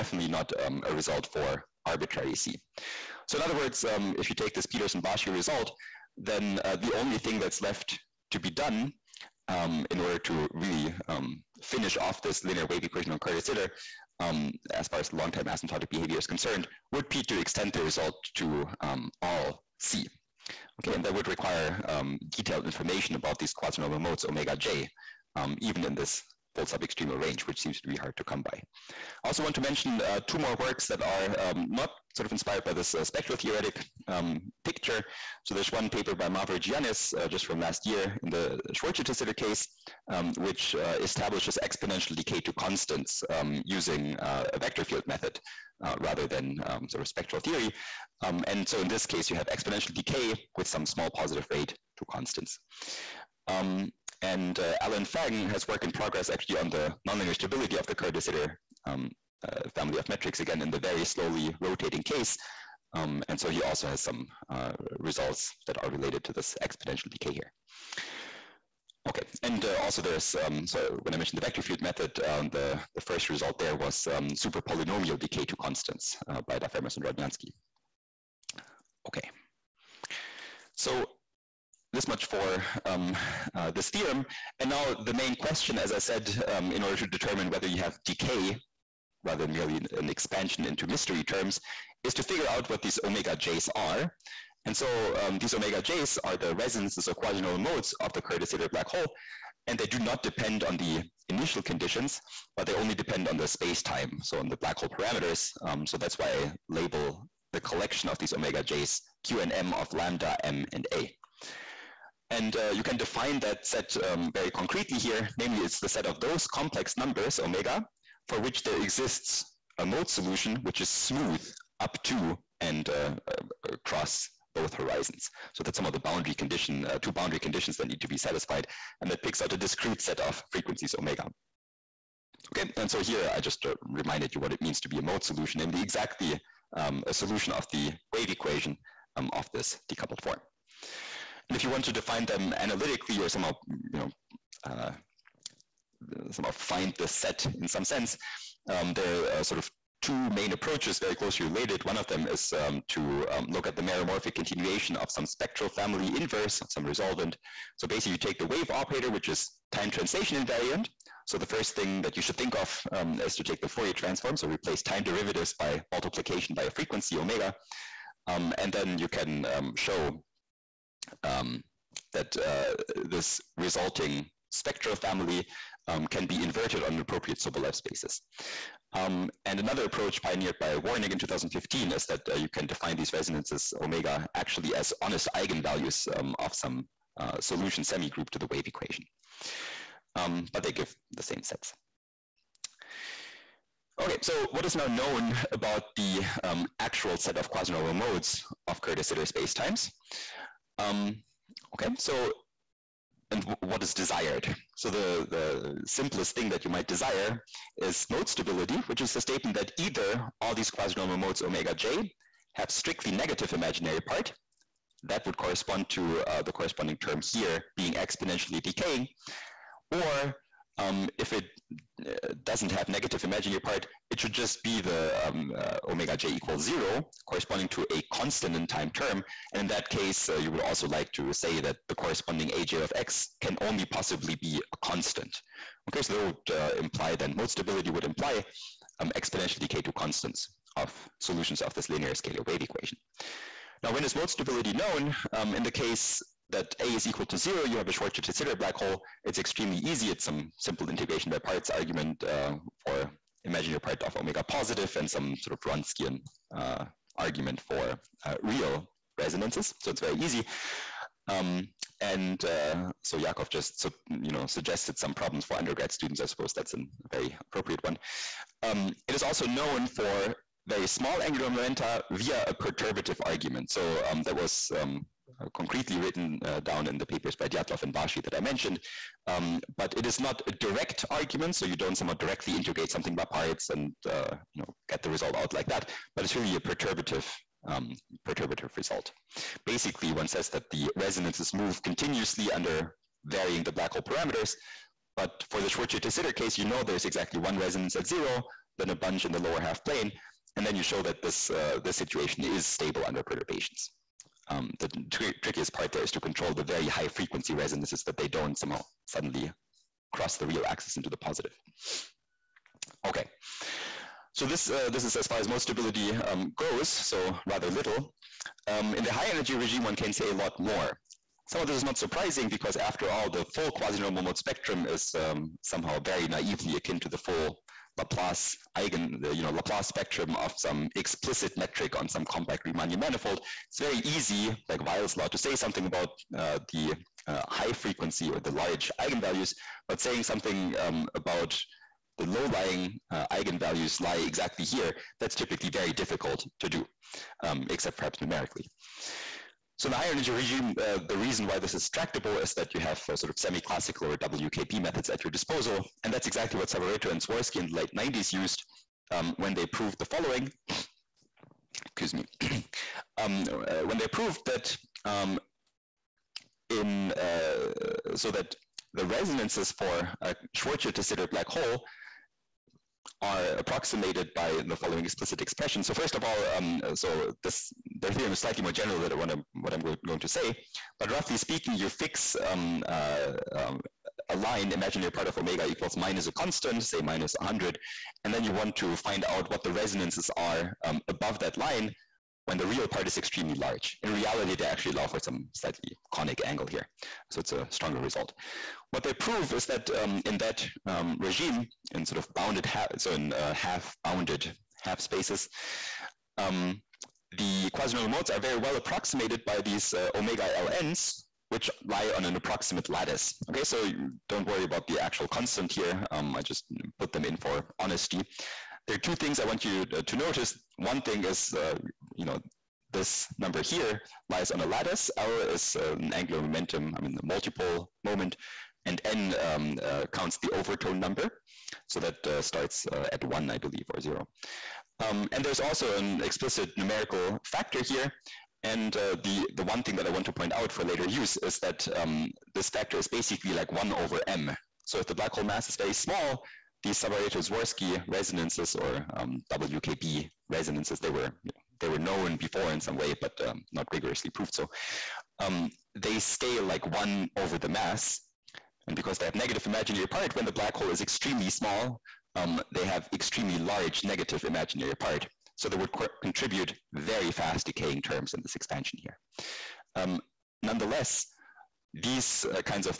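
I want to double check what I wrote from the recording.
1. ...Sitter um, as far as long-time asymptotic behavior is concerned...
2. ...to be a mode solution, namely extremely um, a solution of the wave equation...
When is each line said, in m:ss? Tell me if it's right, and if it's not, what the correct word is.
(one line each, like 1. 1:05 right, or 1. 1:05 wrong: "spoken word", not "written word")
1. 0:13 right
2. 2:14 wrong: "exactly", not "extremely".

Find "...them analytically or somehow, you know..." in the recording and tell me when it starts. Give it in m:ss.
2:22.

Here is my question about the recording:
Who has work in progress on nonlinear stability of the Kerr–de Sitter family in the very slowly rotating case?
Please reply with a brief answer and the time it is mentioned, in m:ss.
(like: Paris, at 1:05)
Allen Fang, at 0:54.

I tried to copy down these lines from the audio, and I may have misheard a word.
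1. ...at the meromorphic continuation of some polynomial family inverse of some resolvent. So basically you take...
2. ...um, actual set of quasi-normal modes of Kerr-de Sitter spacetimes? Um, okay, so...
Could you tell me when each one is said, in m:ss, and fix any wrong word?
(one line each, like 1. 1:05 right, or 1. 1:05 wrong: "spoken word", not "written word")
1. 2:33 wrong: "spectral", not "polynomial"
2. 3:16 right.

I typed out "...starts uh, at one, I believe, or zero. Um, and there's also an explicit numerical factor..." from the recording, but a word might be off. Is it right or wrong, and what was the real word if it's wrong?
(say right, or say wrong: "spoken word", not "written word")
right.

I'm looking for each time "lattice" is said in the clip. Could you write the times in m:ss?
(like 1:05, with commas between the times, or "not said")
6:52, 7:04.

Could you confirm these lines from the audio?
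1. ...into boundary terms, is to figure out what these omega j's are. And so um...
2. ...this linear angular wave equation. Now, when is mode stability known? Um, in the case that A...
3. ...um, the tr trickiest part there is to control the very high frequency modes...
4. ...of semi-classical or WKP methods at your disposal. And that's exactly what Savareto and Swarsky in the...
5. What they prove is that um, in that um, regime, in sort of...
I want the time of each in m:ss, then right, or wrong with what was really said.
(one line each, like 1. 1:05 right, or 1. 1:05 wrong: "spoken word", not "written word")
1. 1:30 wrong: "mystery", not "boundary"
2. 4:01 wrong: "scalar", not "angular"
3. 5:04 wrong: "resonances", not "modes"
4. 5:53 right
5. 6:38 right.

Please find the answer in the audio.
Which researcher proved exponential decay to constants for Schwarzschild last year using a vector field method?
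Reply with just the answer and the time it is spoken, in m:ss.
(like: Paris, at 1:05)
Mavrogiannis, at 0:36.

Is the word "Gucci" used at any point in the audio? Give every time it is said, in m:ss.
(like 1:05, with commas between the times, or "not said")
not said.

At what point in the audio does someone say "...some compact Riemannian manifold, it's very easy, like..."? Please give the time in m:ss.
5:32.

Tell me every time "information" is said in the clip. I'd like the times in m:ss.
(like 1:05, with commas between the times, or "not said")
0:22.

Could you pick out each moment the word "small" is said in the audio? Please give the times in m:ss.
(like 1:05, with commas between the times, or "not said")
0:50, 4:30, 7:25, 7:41.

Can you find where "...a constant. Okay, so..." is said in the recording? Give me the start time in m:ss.
3:54.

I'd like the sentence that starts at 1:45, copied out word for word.
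Um, so that's why I label the collection of these omega j's Q and M of lambda, M, and A.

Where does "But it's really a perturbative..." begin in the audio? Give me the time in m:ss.
4:46.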